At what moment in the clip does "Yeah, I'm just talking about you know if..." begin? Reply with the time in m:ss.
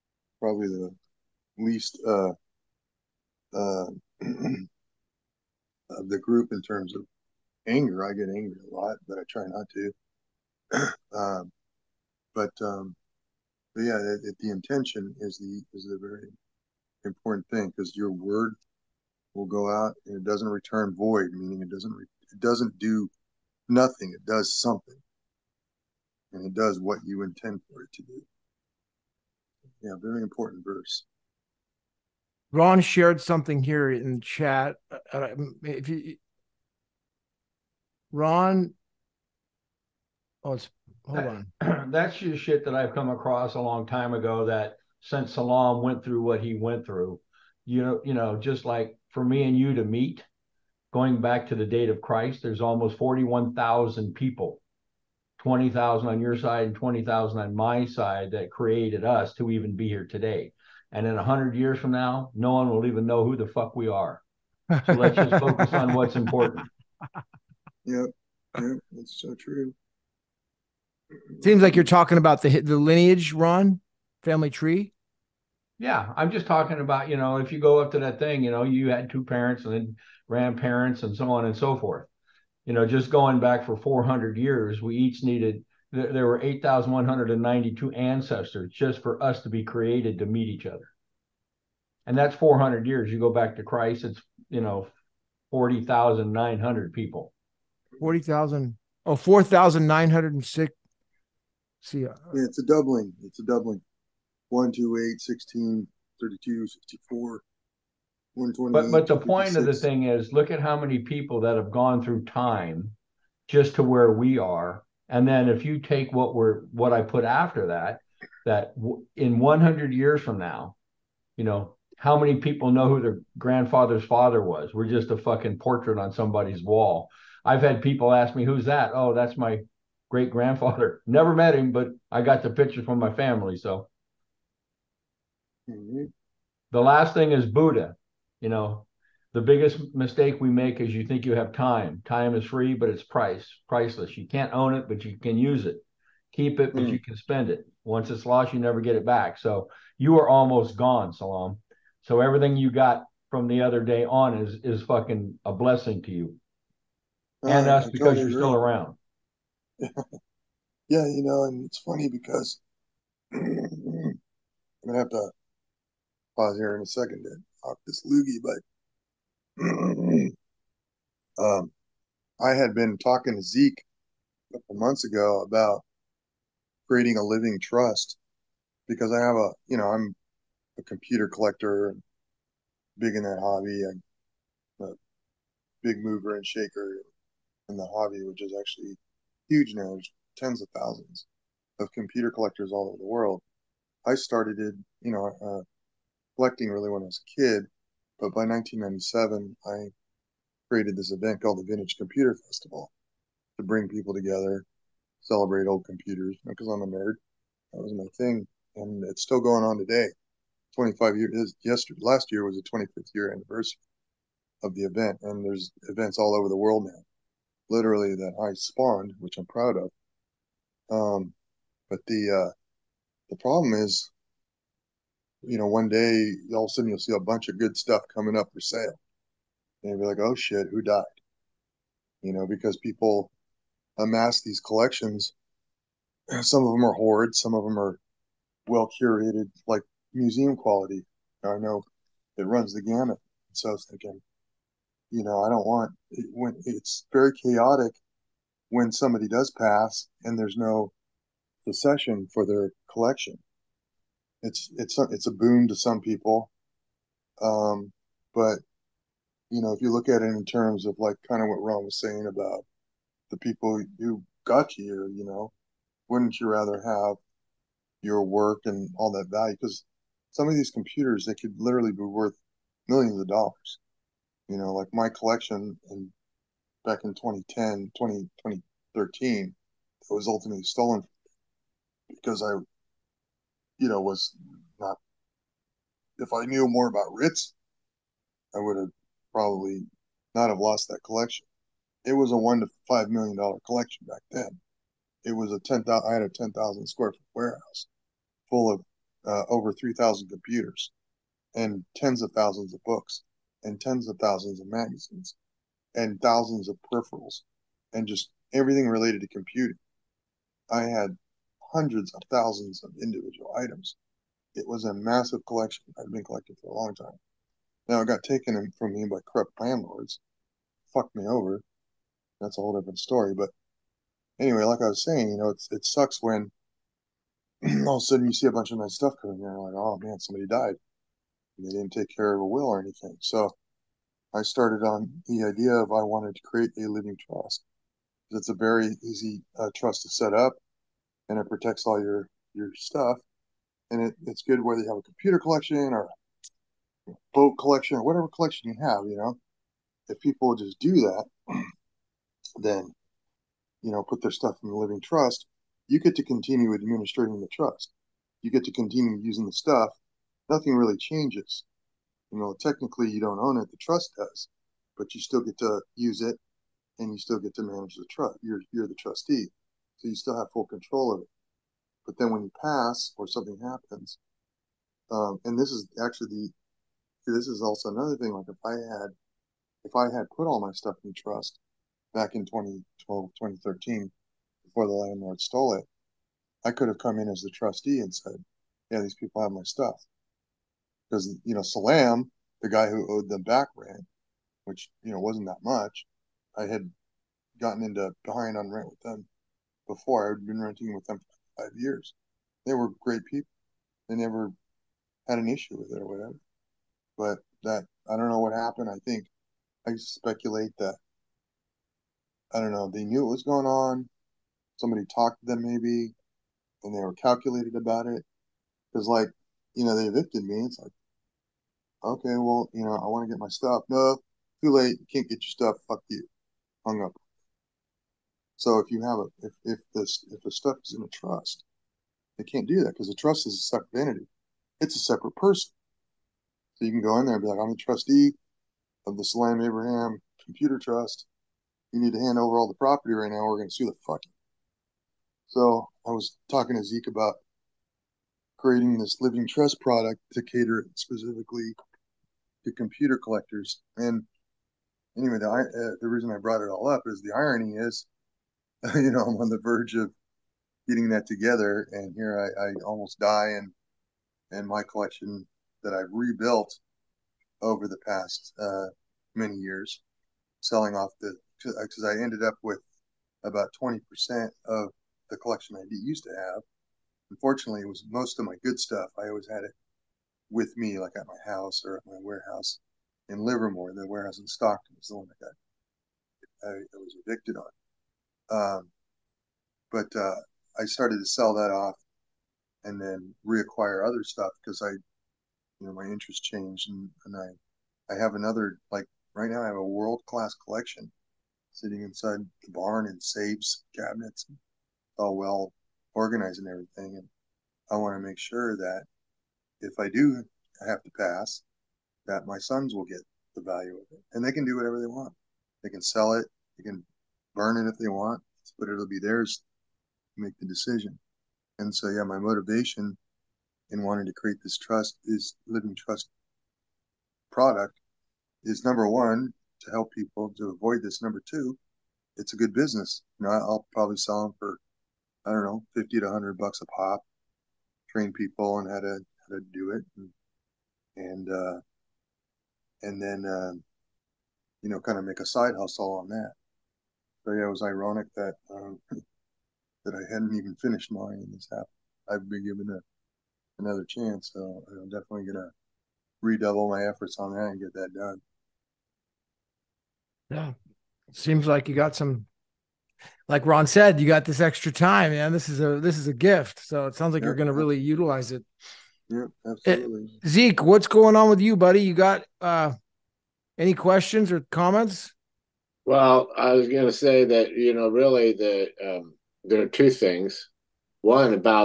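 1:15.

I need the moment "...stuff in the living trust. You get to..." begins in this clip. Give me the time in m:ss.
5:54.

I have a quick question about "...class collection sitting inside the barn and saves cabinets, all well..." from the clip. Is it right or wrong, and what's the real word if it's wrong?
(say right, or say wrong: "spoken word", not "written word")
right.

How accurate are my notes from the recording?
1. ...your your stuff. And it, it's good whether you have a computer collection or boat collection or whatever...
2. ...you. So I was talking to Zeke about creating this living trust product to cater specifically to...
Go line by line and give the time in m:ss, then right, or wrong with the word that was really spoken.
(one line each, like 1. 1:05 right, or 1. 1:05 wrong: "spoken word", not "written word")
1. 5:42 right
2. 7:24 right.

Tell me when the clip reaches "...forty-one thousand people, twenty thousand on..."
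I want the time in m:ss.
0:52.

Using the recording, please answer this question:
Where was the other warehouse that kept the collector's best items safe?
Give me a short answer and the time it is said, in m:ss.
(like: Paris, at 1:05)
Livermore, at 8:03.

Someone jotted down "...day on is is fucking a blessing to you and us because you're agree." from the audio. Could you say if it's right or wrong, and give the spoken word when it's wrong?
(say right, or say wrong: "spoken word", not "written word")
right.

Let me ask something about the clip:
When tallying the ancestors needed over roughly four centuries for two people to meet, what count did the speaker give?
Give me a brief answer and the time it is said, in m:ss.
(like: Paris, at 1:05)
8,192, at 1:26.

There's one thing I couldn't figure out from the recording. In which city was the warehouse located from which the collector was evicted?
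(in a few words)
Stockton.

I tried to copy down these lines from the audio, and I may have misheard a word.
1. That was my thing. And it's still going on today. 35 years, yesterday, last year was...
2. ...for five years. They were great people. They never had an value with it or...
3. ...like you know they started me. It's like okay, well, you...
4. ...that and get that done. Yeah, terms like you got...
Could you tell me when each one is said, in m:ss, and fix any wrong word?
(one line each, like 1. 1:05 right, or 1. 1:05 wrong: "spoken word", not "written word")
1. 3:27 wrong: "25", not "35"
2. 6:41 wrong: "issue", not "value"
3. 6:59 wrong: "evicted", not "started"
4. 9:17 wrong: "seems", not "terms".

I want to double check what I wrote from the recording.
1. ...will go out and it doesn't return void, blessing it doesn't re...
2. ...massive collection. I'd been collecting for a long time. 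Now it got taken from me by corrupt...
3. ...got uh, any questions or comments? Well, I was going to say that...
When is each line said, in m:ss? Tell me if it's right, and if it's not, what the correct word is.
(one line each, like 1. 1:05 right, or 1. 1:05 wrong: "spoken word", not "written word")
1. 0:19 wrong: "meaning", not "blessing"
2. 5:14 right
3. 9:32 right.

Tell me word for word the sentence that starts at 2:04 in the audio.
We're just a fucking portrait on somebody's wall.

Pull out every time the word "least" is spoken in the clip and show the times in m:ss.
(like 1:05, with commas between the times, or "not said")
0:01.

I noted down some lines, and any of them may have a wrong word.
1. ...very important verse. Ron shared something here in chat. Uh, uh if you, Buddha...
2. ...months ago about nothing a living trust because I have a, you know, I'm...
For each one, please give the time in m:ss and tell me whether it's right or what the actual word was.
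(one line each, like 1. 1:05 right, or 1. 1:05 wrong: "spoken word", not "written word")
1. 0:30 wrong: "Ron", not "Buddha"
2. 2:54 wrong: "creating", not "nothing".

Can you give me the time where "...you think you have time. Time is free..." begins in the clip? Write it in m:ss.
2:20.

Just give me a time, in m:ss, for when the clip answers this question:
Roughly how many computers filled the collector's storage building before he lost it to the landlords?
4:59.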